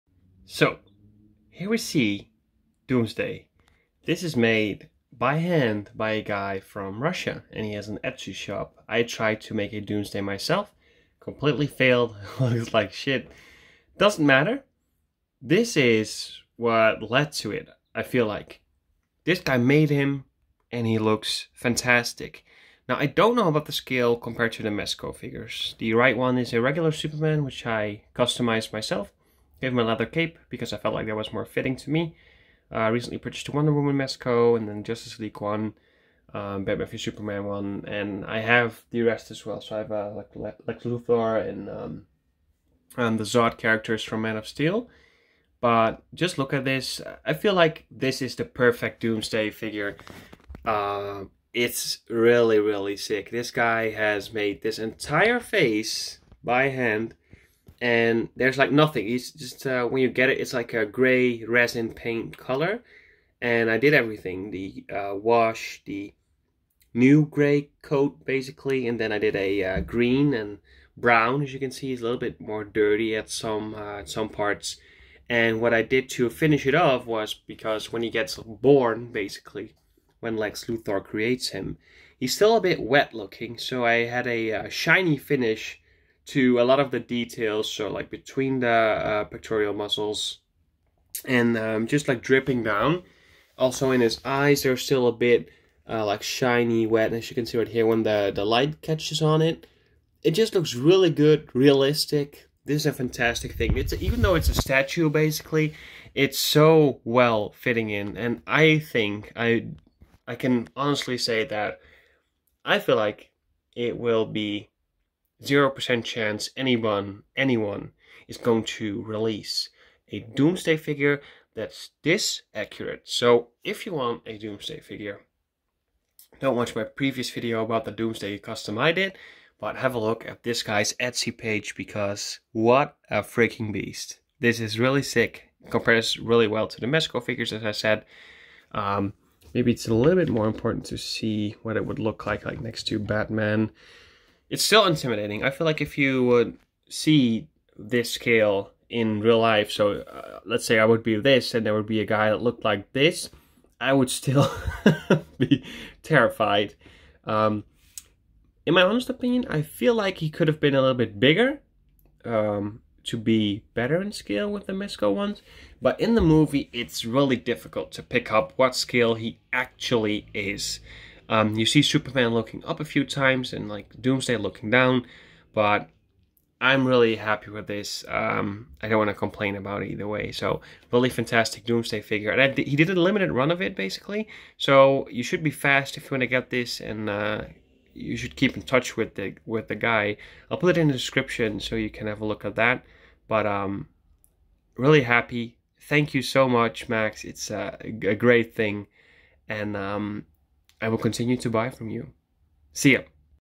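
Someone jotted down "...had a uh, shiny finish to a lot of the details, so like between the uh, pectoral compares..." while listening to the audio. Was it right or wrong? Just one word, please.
wrong.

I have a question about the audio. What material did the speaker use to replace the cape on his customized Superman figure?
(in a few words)
Leather.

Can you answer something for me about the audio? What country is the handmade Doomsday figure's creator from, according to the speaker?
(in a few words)
Russia.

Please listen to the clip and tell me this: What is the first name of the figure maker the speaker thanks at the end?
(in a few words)
Max.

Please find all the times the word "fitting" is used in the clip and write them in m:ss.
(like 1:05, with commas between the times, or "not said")
0:31, 1:47.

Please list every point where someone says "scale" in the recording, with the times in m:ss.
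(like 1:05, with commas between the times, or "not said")
0:23, 2:28, 2:44, 2:48.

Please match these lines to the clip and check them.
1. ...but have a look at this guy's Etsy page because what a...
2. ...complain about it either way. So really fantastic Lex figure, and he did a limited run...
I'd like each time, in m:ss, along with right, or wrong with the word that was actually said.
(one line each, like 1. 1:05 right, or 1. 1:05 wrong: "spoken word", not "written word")
1. 2:09 right
2. 2:59 wrong: "Doomsday", not "Lex".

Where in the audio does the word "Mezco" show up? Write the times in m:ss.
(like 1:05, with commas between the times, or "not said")
0:24, 0:33, 2:16, 2:44.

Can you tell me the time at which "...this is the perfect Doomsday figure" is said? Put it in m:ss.
0:47.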